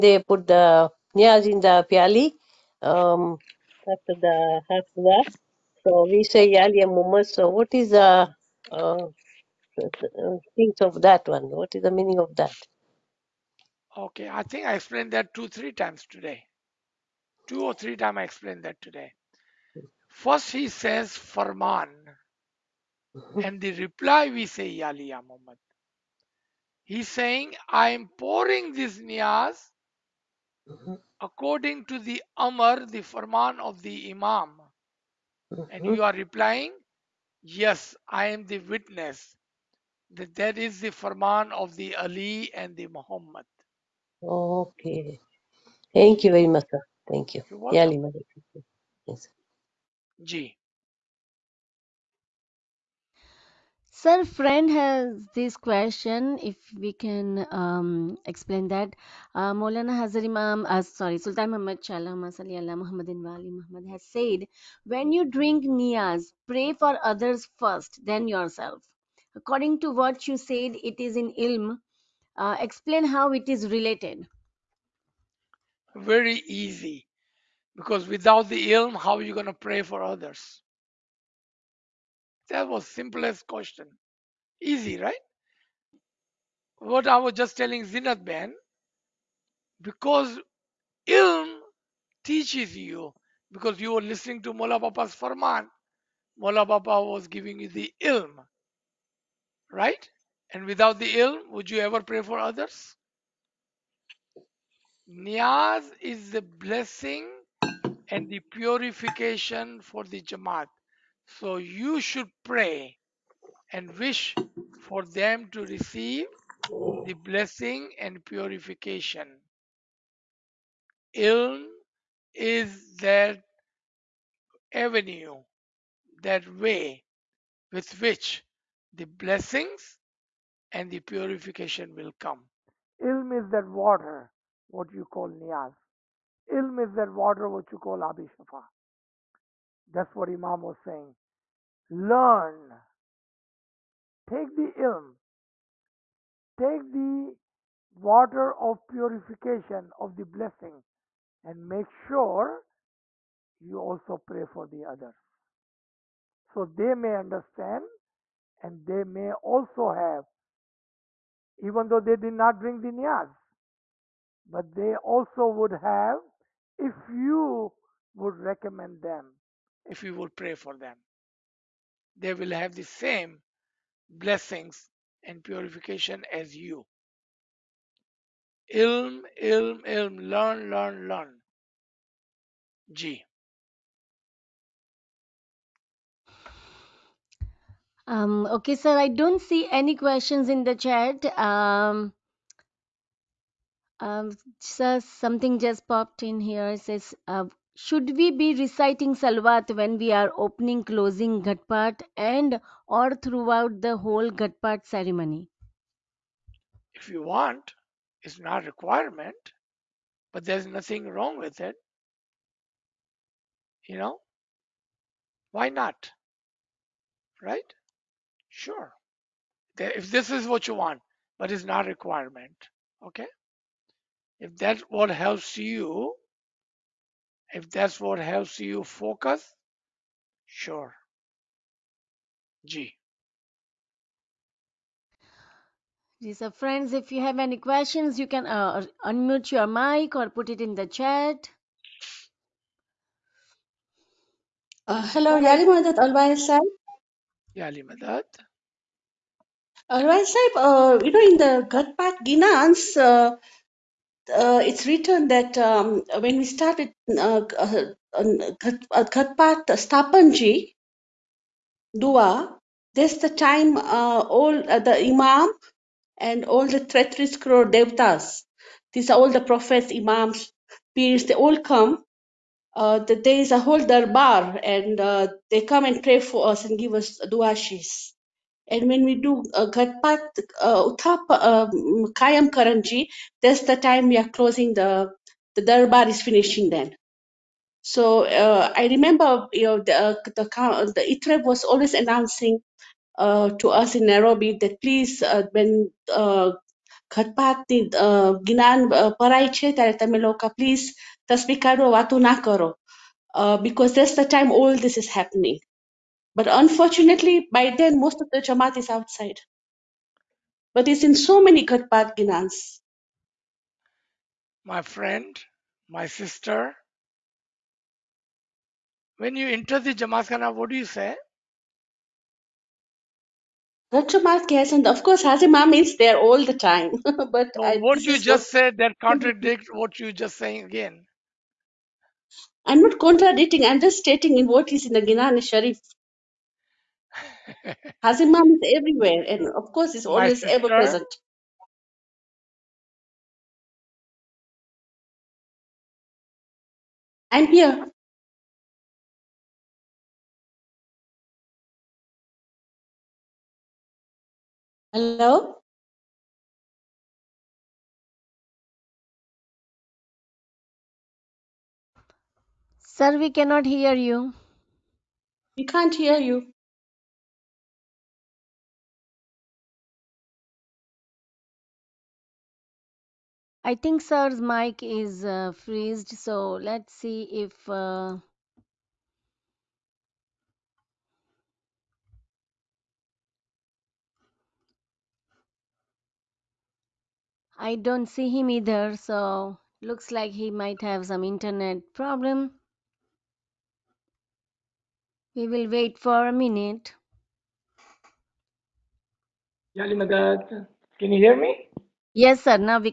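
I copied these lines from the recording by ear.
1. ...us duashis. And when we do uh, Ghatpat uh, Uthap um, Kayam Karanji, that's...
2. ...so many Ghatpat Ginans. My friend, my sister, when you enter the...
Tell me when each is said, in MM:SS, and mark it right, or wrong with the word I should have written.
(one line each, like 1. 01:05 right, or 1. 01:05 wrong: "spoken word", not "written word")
1. 04:36 right
2. 05:11 right.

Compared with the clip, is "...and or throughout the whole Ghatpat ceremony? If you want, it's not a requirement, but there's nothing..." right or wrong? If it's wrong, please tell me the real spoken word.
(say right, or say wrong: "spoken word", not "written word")
right.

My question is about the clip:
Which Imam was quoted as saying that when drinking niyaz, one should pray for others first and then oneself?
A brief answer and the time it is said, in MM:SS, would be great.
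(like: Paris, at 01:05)
Sultan Muhammad Shah, at 01:01.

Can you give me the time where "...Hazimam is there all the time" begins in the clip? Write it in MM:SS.
05:25.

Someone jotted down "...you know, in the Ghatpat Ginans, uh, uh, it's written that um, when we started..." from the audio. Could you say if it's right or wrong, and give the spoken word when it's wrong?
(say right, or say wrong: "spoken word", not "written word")
right.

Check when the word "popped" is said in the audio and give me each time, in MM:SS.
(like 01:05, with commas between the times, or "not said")
03:15.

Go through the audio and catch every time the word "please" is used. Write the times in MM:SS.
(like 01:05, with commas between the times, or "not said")
04:54, 05:00.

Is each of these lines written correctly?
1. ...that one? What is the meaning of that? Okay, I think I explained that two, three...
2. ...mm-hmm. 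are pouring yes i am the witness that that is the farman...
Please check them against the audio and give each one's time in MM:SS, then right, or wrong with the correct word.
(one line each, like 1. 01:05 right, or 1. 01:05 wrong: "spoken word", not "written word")
1. 00:11 right
2. 00:35 wrong: "replying", not "pouring".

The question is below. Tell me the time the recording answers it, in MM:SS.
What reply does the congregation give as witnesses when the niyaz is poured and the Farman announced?
00:24.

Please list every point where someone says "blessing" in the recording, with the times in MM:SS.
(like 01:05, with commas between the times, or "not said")
01:46, 01:57, 02:09, 02:30, 02:54.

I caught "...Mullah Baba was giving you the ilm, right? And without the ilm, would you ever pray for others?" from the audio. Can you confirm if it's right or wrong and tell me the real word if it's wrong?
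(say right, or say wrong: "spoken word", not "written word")
right.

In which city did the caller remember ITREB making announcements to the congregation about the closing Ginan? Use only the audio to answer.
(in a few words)
Nairobi.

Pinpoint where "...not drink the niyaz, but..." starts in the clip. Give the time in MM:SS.
02:42.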